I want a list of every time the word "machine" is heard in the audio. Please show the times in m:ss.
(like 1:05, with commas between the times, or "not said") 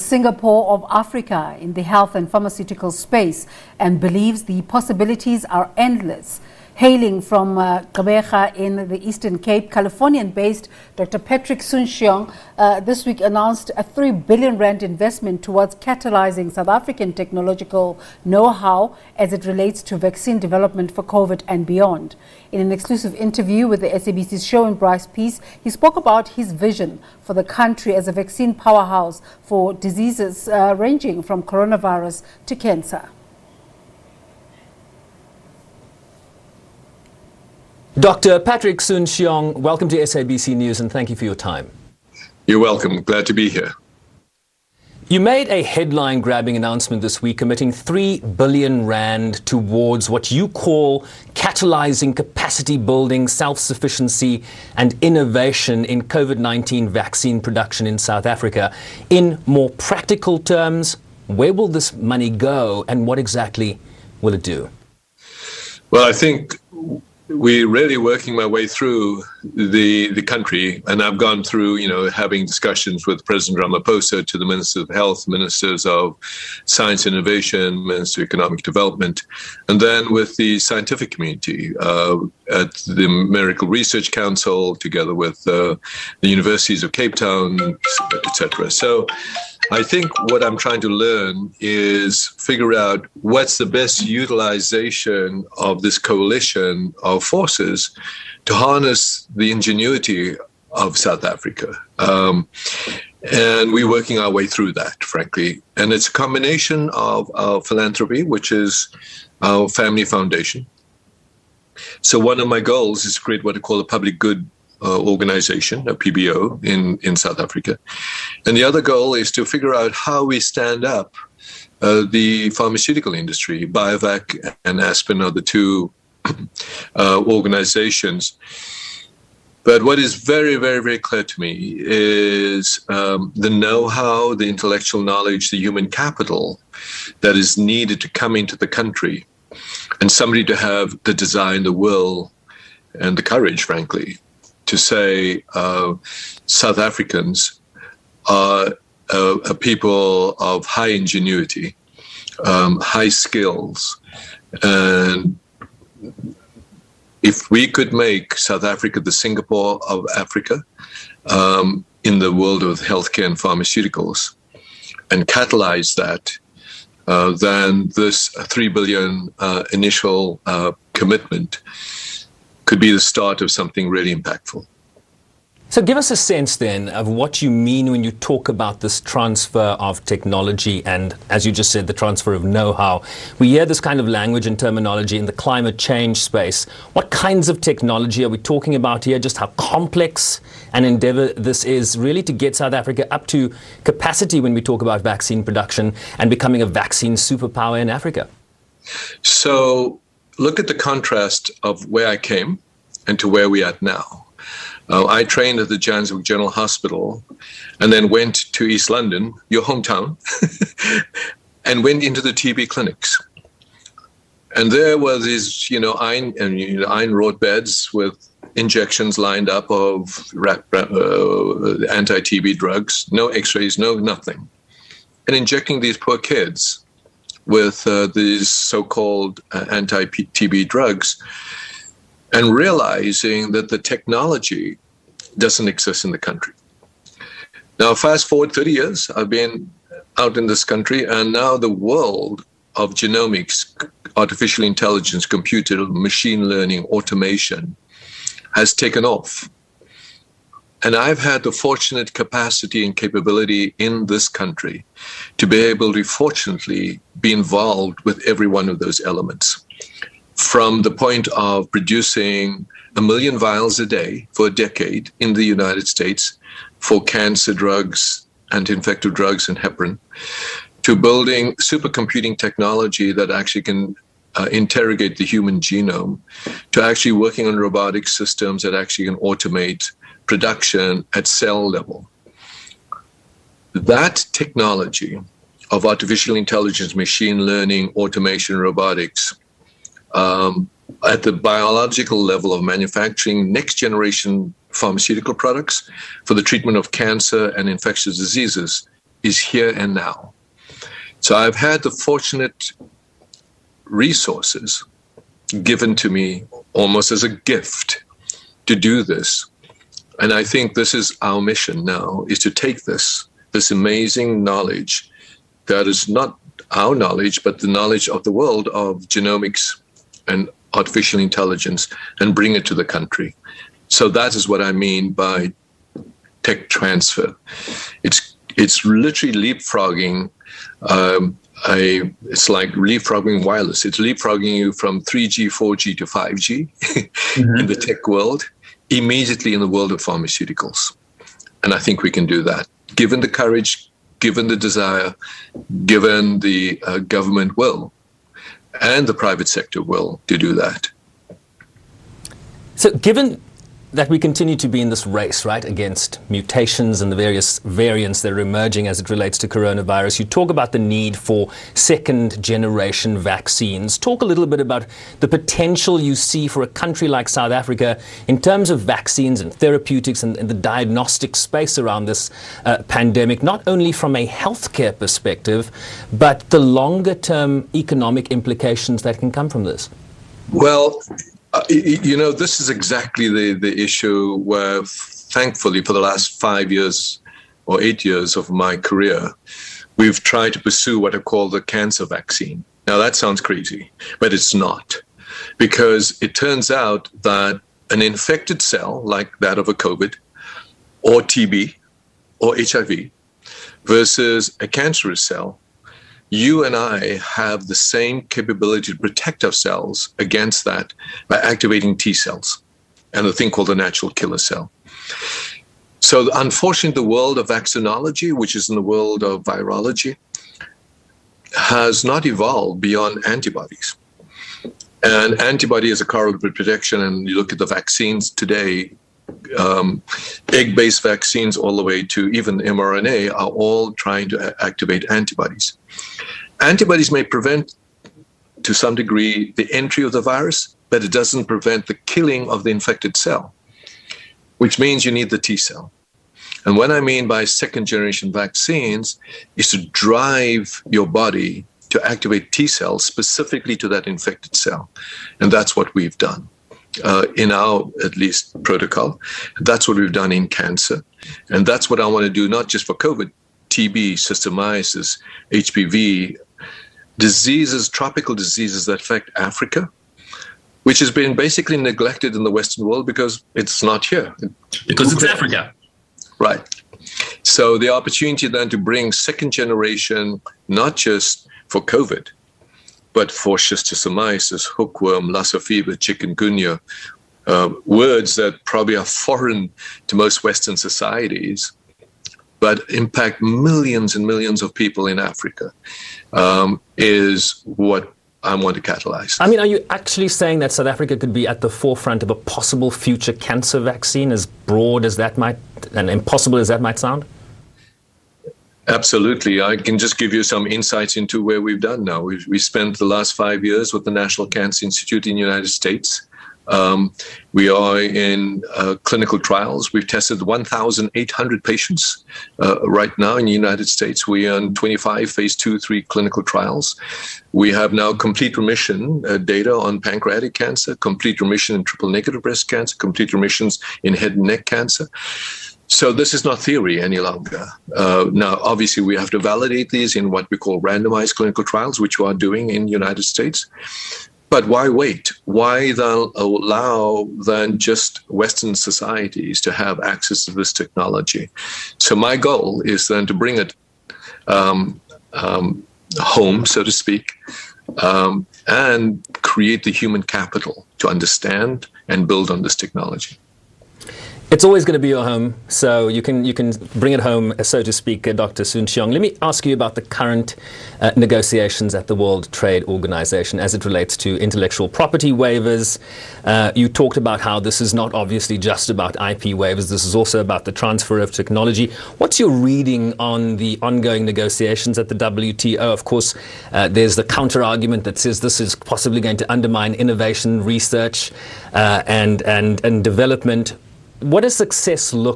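4:05, 4:46.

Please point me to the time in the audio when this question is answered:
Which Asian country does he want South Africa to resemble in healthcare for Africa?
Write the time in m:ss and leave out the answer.
2:39.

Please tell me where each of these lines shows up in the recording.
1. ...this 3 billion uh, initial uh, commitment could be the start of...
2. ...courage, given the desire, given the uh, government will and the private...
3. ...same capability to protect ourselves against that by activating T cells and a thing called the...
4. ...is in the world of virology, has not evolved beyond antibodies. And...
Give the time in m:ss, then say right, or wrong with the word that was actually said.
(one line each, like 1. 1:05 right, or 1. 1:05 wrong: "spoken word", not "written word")
1. 2:47 right
2. 5:43 right
3. 6:47 right
4. 6:58 right.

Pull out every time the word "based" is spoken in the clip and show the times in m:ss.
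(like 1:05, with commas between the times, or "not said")
0:09, 7:10.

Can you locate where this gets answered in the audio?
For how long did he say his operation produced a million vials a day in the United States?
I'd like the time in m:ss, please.
4:24.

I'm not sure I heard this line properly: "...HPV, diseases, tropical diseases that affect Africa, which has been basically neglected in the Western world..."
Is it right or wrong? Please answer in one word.
right.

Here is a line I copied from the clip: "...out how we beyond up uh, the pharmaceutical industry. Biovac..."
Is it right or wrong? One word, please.
wrong.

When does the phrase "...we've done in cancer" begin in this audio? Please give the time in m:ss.
7:39.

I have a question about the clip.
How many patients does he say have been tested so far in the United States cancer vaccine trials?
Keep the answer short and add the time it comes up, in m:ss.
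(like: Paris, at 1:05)
1,800, at 8:40.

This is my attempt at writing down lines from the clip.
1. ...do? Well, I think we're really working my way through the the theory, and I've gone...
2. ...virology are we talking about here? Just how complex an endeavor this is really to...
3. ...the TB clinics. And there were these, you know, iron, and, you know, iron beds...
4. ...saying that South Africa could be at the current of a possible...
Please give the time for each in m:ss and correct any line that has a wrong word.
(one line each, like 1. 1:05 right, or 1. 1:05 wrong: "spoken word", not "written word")
1. 1:04 wrong: "country", not "theory"
2. 3:07 wrong: "technology", not "virology"
3. 3:32 right
4. 8:20 wrong: "forefront", not "current".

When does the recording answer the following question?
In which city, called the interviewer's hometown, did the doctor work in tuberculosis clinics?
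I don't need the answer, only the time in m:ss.
3:28.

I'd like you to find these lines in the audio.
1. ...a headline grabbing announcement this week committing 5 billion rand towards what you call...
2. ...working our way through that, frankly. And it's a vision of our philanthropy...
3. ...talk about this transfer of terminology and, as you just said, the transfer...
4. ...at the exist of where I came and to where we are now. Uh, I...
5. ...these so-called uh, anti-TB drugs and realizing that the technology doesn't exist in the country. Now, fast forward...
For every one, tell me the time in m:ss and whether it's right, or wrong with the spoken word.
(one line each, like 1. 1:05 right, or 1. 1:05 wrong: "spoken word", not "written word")
1. 0:45 wrong: "3", not "5"
2. 1:43 wrong: "combination", not "vision"
3. 2:58 wrong: "technology", not "terminology"
4. 3:20 wrong: "contrast", not "exist"
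5. 3:48 right.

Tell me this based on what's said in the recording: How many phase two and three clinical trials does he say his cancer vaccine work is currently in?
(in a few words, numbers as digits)
25.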